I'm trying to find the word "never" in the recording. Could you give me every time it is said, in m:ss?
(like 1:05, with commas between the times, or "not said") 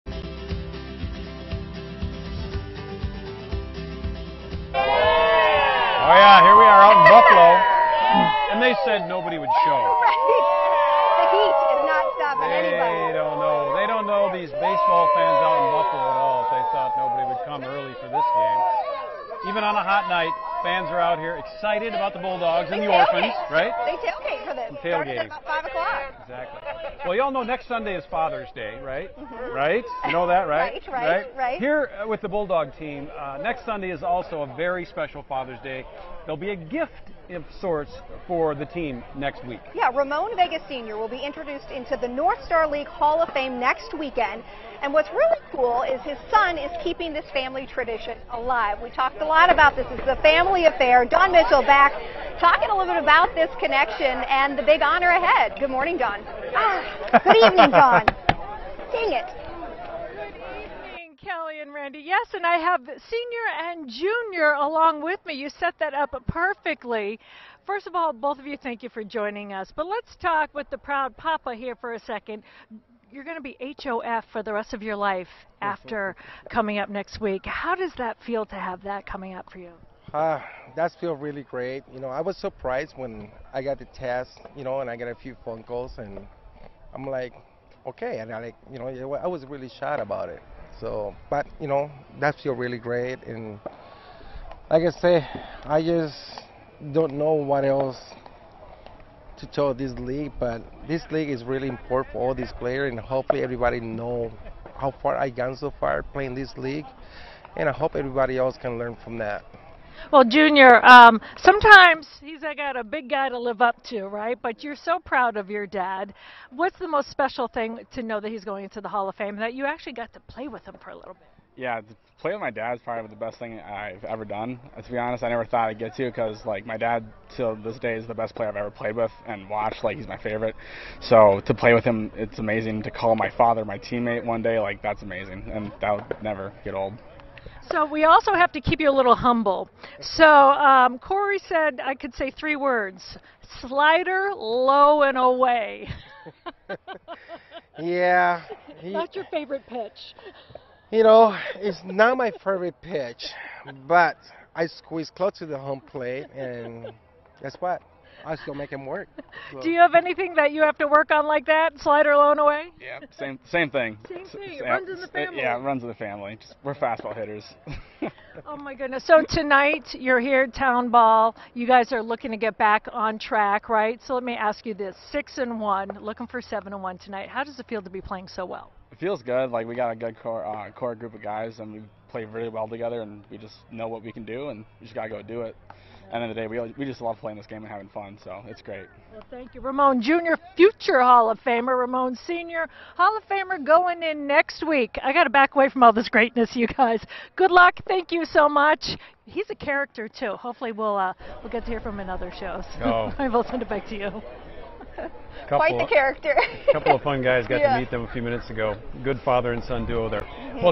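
2:05, 2:16.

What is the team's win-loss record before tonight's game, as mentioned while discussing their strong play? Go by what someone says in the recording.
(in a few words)
6-1.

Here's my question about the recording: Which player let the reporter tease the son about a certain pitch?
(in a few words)
Corey.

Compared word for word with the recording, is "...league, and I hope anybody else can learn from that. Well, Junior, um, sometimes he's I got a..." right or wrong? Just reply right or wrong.
wrong.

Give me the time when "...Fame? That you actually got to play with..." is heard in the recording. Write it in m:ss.
1:59.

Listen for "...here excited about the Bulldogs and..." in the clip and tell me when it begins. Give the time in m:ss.
0:21.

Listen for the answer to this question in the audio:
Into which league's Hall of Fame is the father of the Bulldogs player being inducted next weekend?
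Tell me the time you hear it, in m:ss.
0:42.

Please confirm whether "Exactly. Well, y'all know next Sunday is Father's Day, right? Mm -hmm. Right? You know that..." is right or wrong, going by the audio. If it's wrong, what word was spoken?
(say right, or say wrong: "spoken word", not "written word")
right.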